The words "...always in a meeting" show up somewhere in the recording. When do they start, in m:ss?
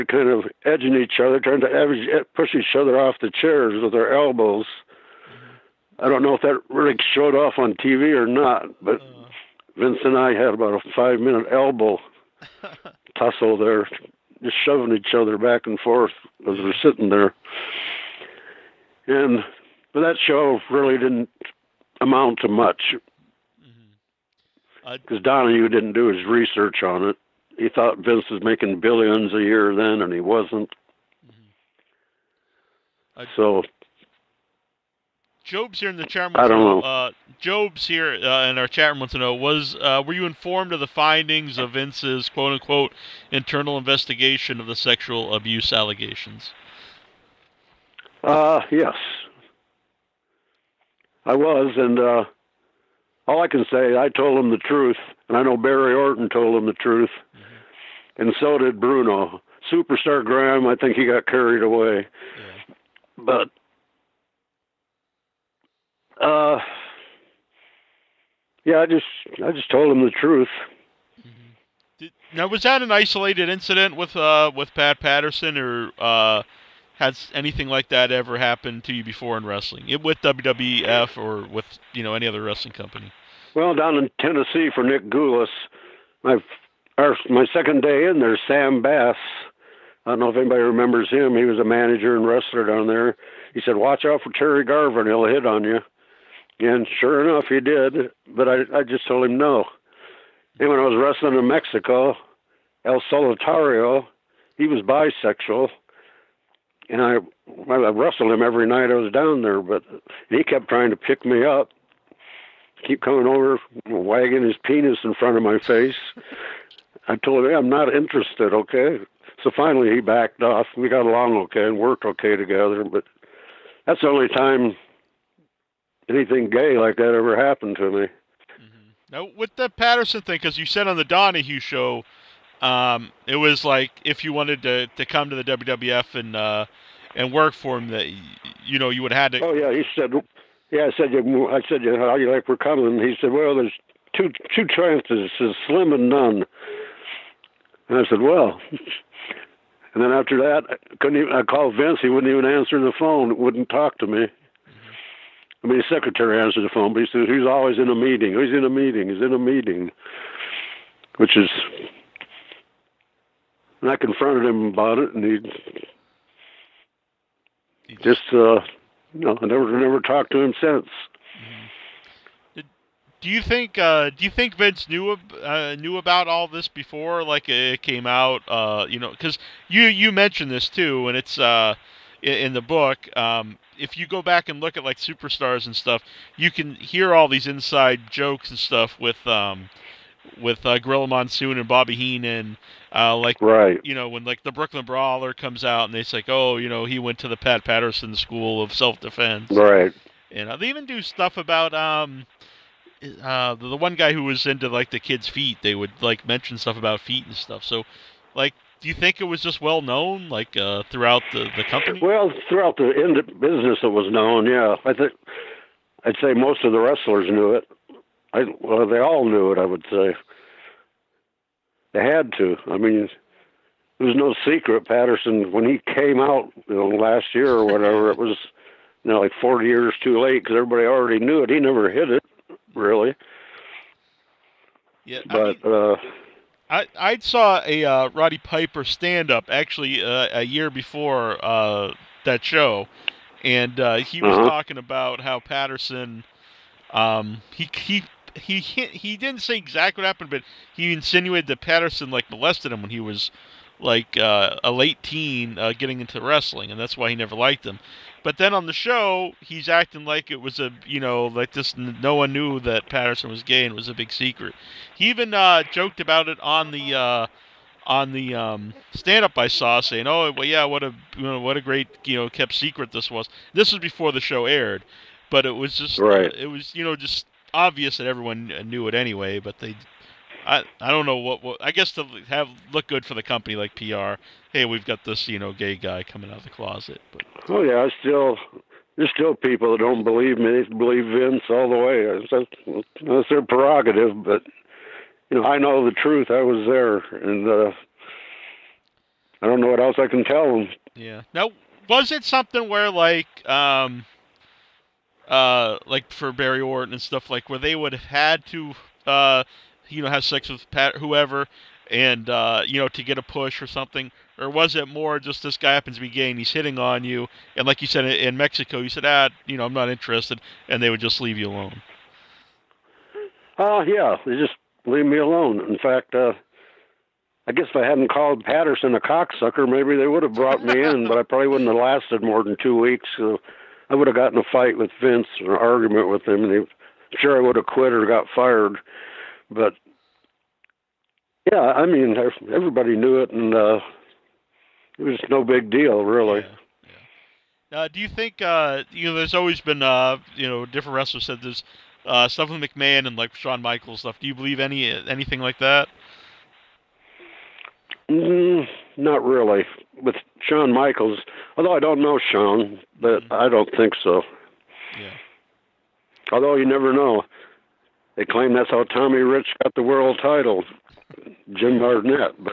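2:37.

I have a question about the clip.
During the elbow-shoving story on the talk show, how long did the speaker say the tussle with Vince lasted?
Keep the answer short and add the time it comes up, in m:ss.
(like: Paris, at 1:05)
5 minutes, at 0:10.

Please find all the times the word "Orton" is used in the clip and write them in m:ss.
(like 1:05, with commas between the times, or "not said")
0:55, 5:06.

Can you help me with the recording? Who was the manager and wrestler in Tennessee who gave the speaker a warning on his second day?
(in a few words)
Sam Bass.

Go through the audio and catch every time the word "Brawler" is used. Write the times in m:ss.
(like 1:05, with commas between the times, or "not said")
3:14.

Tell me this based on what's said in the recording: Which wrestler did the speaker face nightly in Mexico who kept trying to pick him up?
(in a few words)
El Solitario.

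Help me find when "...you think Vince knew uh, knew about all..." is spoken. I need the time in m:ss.
2:54.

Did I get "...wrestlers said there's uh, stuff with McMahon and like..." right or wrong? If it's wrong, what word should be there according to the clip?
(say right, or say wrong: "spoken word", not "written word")
right.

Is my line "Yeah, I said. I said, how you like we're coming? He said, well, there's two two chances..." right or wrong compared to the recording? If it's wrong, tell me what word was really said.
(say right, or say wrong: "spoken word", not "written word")
right.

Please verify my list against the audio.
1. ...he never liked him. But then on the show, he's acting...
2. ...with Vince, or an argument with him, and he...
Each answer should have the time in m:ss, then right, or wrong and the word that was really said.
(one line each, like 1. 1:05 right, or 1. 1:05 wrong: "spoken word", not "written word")
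1. 4:17 right
2. 5:34 right.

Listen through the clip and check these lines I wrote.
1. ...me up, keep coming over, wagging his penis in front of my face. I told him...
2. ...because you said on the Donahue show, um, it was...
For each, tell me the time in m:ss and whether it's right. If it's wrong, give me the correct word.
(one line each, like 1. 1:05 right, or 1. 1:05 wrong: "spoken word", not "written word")
1. 1:51 right
2. 2:10 right.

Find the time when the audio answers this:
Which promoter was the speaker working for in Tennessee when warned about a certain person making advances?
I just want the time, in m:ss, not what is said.
1:24.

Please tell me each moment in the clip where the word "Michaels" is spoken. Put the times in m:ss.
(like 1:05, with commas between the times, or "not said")
5:53, 6:00.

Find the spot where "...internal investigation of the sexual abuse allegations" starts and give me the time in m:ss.
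0:43.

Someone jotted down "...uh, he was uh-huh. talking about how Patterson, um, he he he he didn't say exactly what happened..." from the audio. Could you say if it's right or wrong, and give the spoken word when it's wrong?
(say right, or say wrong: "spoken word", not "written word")
right.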